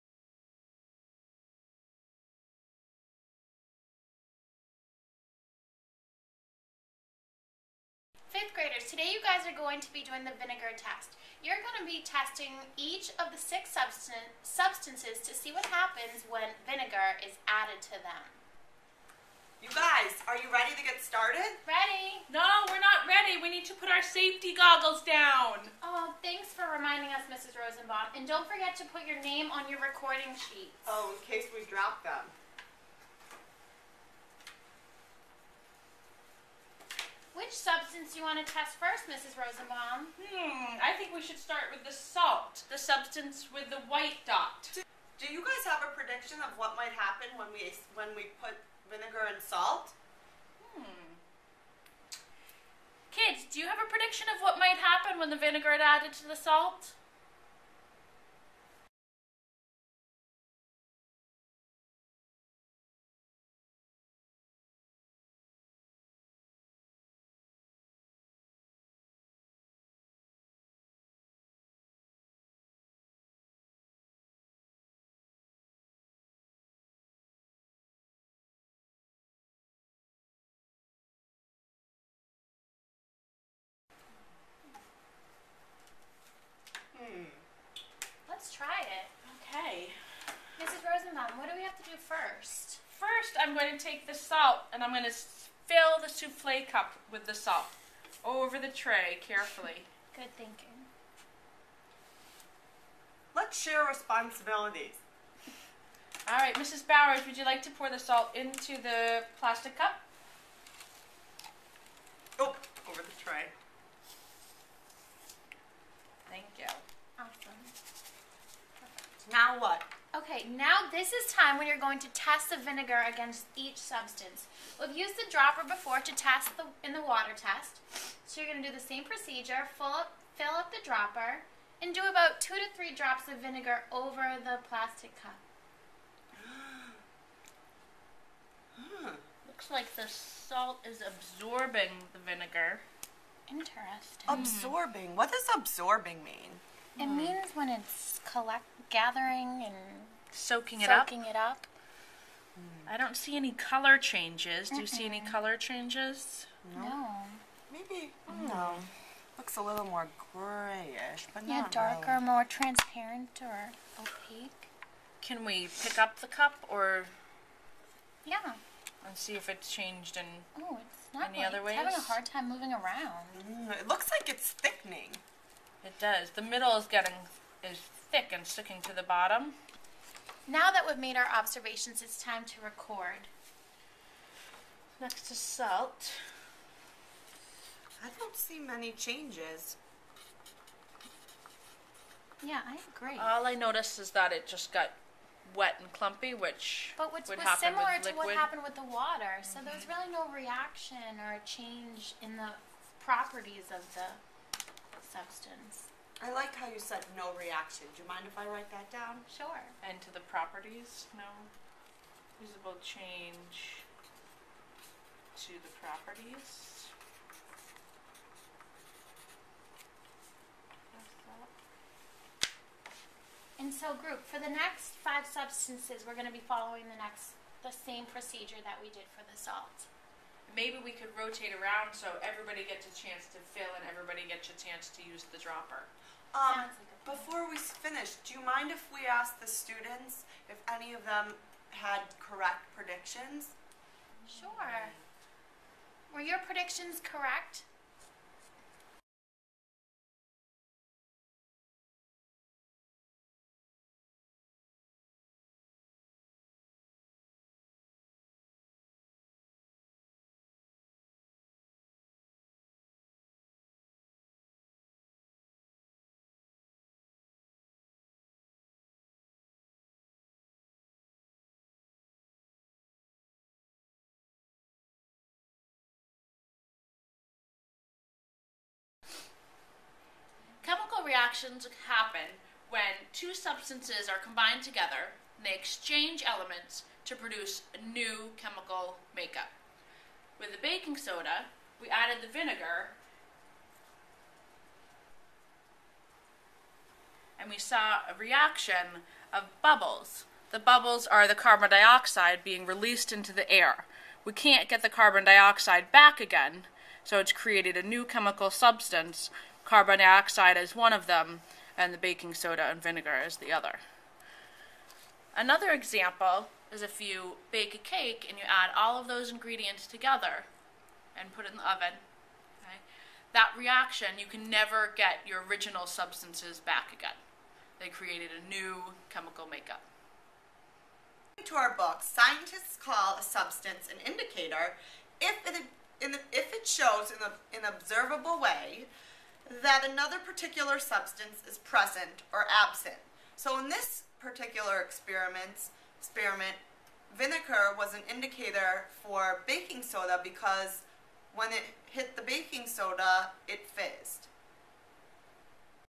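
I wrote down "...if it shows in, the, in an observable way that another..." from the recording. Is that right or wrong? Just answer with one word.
right.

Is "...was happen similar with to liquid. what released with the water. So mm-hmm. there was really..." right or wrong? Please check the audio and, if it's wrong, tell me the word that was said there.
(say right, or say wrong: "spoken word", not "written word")
wrong: "happened", not "released".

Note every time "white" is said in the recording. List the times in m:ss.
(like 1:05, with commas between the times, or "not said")
0:43.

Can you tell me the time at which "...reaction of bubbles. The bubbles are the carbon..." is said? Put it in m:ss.
4:58.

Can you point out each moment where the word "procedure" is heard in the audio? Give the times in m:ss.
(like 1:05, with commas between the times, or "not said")
2:09, 3:48.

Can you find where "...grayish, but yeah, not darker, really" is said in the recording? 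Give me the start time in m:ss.
2:40.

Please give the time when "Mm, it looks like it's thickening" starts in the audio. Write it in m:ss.
2:53.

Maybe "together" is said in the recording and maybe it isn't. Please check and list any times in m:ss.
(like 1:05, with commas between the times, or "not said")
4:44, 5:19.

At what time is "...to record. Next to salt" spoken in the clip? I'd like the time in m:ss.
3:02.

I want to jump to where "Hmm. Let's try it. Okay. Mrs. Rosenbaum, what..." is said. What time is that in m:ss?
1:26.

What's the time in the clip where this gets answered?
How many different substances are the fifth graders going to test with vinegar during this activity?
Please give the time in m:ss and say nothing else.
0:13.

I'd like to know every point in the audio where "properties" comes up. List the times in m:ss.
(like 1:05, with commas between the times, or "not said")
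3:23, 3:30, 3:35.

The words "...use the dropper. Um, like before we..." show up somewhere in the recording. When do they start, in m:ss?
3:55.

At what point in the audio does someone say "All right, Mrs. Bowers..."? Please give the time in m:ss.
1:46.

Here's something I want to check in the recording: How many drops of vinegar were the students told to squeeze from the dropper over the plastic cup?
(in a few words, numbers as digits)
2 to 3.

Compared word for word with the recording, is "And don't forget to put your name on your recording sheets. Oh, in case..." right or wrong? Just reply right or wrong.
right.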